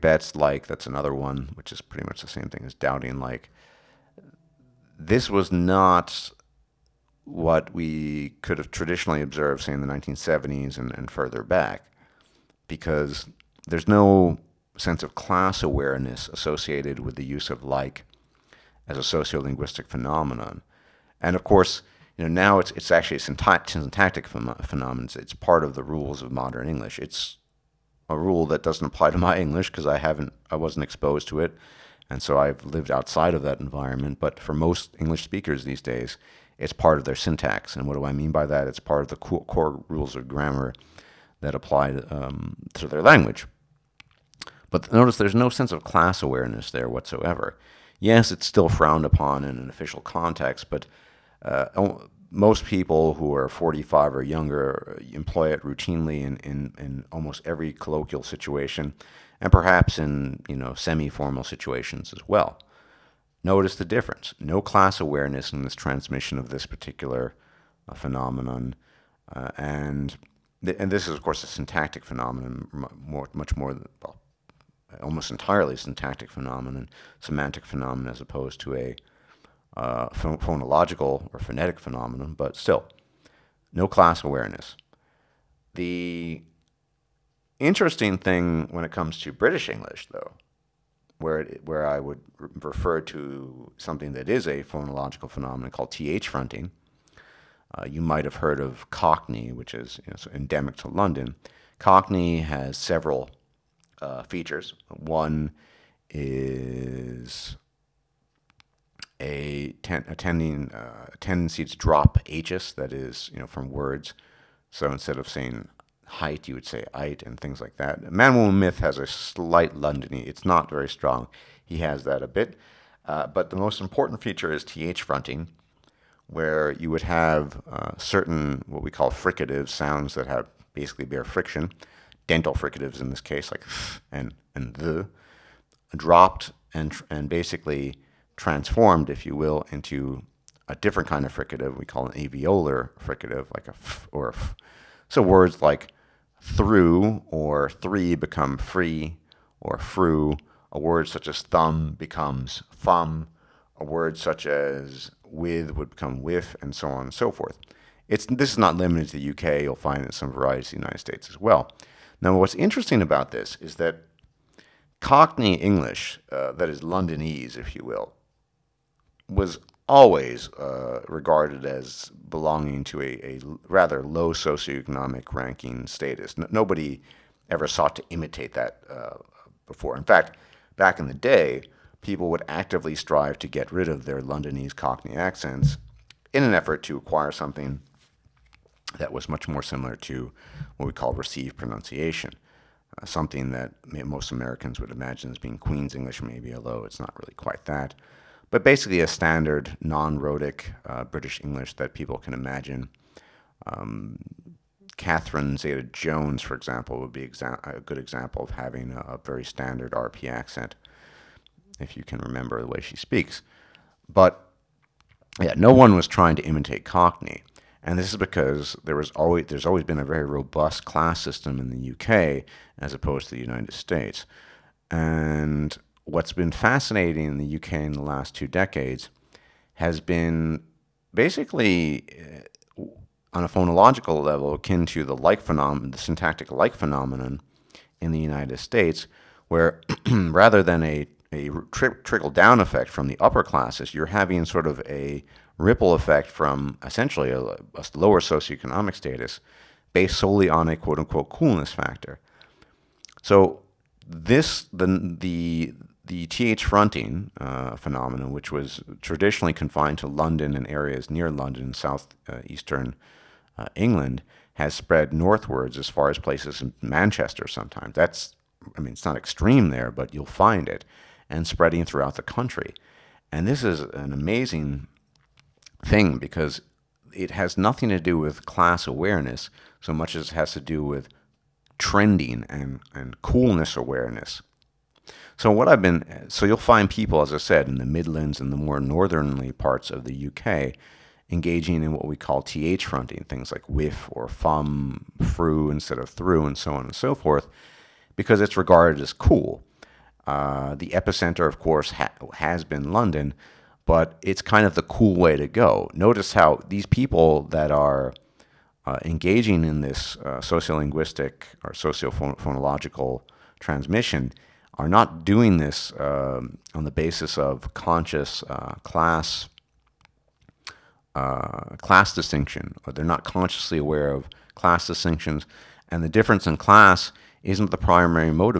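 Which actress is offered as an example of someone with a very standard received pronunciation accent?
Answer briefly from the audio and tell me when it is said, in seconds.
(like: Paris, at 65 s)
Catherine Zeta-Jones, at 204 s.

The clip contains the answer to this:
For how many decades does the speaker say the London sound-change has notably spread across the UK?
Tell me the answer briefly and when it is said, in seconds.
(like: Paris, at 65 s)
2, at 228 s.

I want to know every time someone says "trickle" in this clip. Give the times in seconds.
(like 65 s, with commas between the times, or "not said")
242 s.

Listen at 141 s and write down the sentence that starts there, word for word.
We call an alveolar fricative, like a f or a f.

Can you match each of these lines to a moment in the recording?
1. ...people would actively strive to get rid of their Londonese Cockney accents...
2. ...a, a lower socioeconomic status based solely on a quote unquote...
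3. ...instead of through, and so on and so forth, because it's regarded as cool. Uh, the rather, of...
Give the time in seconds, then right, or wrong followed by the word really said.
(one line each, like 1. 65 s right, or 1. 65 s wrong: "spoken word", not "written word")
1. 182 s right
2. 247 s right
3. 295 s wrong: "epicenter", not "rather".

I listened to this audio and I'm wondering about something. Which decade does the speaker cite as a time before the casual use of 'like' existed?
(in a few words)
1970s.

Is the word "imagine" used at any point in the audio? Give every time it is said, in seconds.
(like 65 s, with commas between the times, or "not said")
194 s, 202 s.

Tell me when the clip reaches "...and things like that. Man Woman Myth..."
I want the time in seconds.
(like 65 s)
117 s.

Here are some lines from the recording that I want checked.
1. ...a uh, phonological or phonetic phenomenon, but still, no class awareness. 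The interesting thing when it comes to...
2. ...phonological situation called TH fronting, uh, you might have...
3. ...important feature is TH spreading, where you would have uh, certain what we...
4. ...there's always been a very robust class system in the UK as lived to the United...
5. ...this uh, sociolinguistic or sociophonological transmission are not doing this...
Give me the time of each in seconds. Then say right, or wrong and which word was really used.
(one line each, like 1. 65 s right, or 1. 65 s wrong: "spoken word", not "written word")
1. 78 s right
2. 94 s wrong: "phenomenon", not "situation"
3. 123 s wrong: "fronting", not "spreading"
4. 219 s wrong: "opposed", not "lived"
5. 309 s right.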